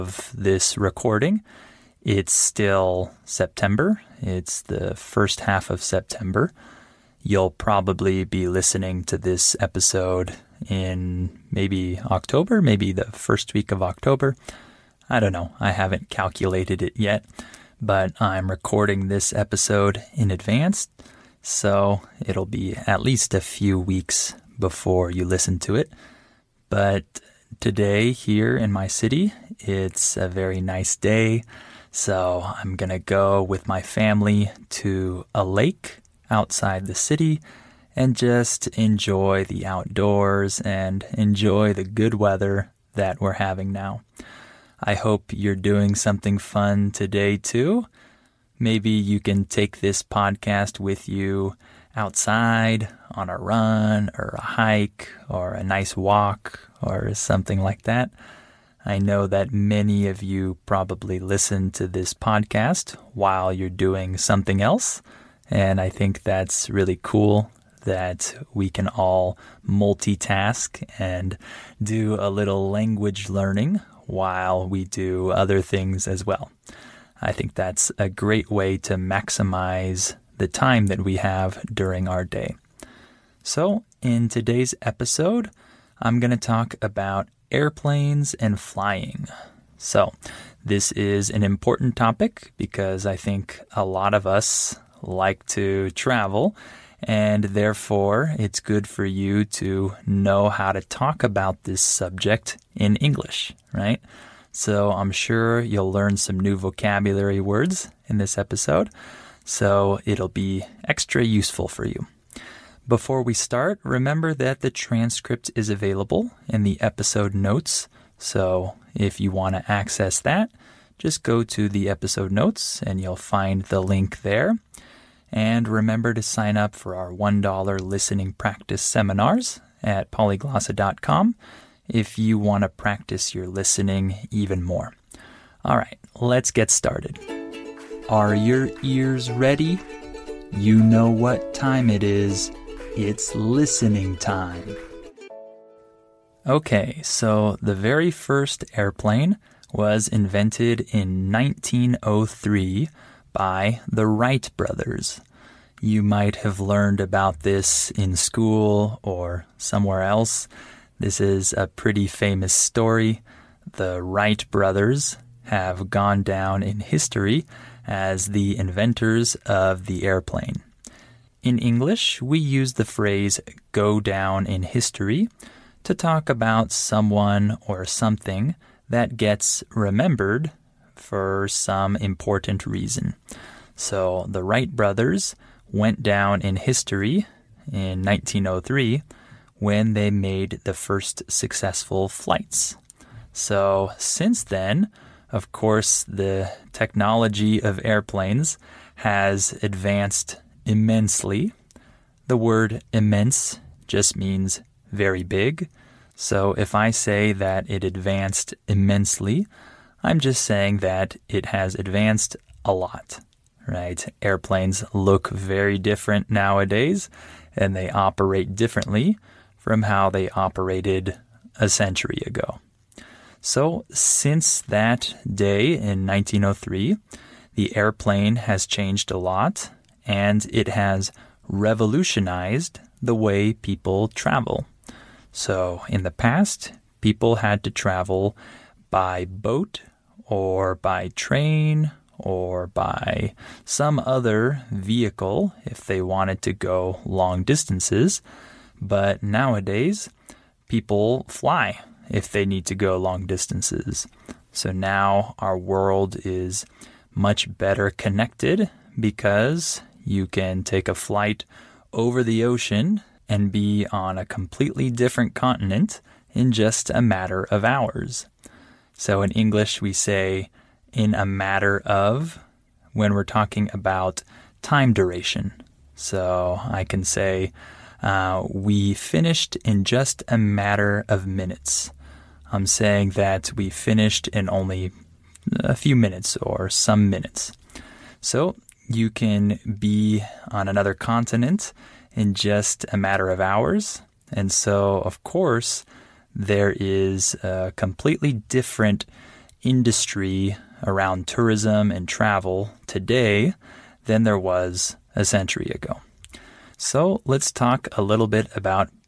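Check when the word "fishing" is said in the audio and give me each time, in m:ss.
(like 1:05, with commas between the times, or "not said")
not said.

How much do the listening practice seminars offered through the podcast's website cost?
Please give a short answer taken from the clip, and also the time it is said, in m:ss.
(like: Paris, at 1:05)
$1, at 2:07.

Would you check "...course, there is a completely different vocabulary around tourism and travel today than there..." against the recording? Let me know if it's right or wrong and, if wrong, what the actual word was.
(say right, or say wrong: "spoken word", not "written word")
wrong: "industry", not "vocabulary".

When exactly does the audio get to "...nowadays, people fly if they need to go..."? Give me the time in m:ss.
4:09.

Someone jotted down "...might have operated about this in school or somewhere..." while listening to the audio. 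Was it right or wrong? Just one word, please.
wrong.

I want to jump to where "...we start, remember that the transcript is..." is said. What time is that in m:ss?
1:53.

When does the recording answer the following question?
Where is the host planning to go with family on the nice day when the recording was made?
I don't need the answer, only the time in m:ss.
0:35.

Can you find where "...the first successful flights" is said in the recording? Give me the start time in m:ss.
3:10.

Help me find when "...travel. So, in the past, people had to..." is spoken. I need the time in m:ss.
3:54.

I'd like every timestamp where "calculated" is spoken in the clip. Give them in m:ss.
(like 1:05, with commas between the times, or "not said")
0:16.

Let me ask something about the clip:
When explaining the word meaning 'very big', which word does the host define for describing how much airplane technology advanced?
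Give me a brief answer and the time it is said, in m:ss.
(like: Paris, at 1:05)
immense, at 3:22.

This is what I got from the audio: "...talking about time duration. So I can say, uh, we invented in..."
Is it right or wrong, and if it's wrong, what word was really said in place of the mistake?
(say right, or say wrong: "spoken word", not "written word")
wrong: "finished", not "invented".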